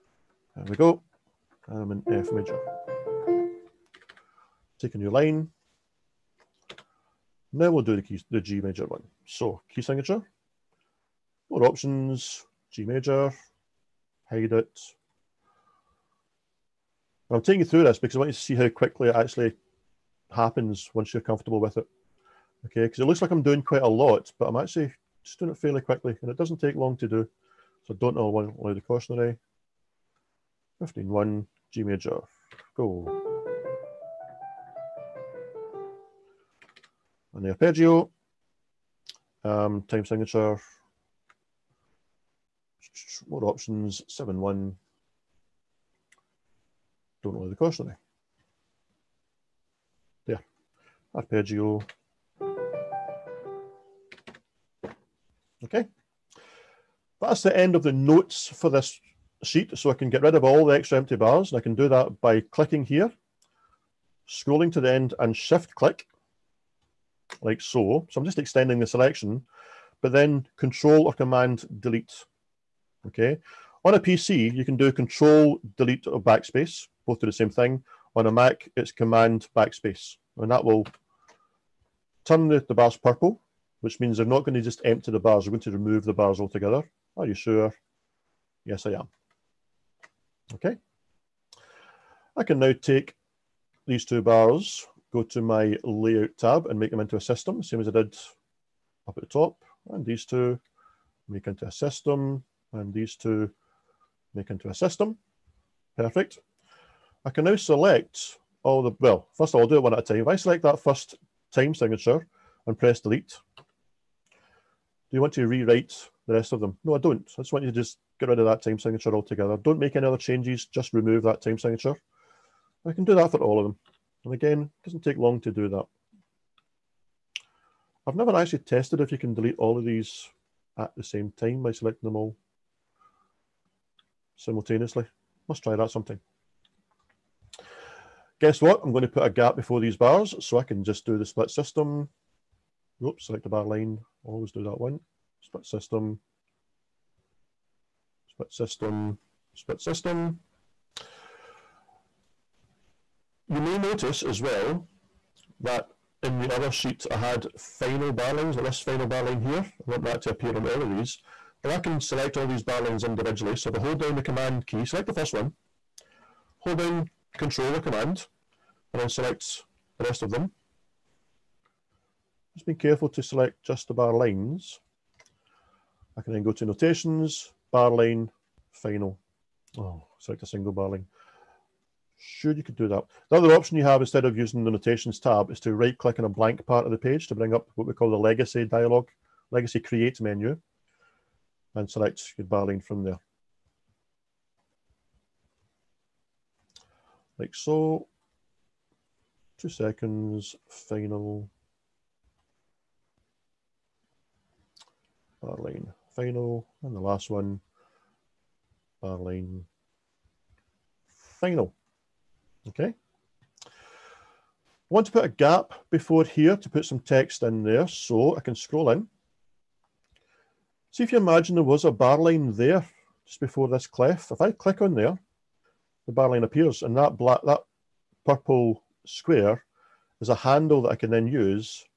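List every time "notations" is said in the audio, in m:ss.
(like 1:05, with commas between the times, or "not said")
2:56, 3:04.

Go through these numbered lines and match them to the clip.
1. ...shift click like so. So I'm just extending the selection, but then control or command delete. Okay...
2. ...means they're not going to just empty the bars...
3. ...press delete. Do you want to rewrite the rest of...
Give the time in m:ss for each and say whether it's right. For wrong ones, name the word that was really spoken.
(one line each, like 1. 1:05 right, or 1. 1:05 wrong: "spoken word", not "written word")
1. 1:05 right
2. 1:23 right
3. 1:52 right.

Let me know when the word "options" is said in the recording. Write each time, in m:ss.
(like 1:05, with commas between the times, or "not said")
0:11, 0:43, 3:03.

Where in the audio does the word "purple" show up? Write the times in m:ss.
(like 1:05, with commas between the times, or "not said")
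1:22, 3:48.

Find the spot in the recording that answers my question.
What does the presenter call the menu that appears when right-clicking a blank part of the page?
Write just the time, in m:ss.
3:08.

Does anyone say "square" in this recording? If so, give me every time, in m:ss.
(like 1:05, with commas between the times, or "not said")
3:49.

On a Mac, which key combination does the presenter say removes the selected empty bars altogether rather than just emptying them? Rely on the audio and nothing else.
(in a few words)
Command backspace.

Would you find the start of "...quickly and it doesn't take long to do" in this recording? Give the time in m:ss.
0:25.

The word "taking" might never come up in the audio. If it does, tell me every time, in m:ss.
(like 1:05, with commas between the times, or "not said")
0:17.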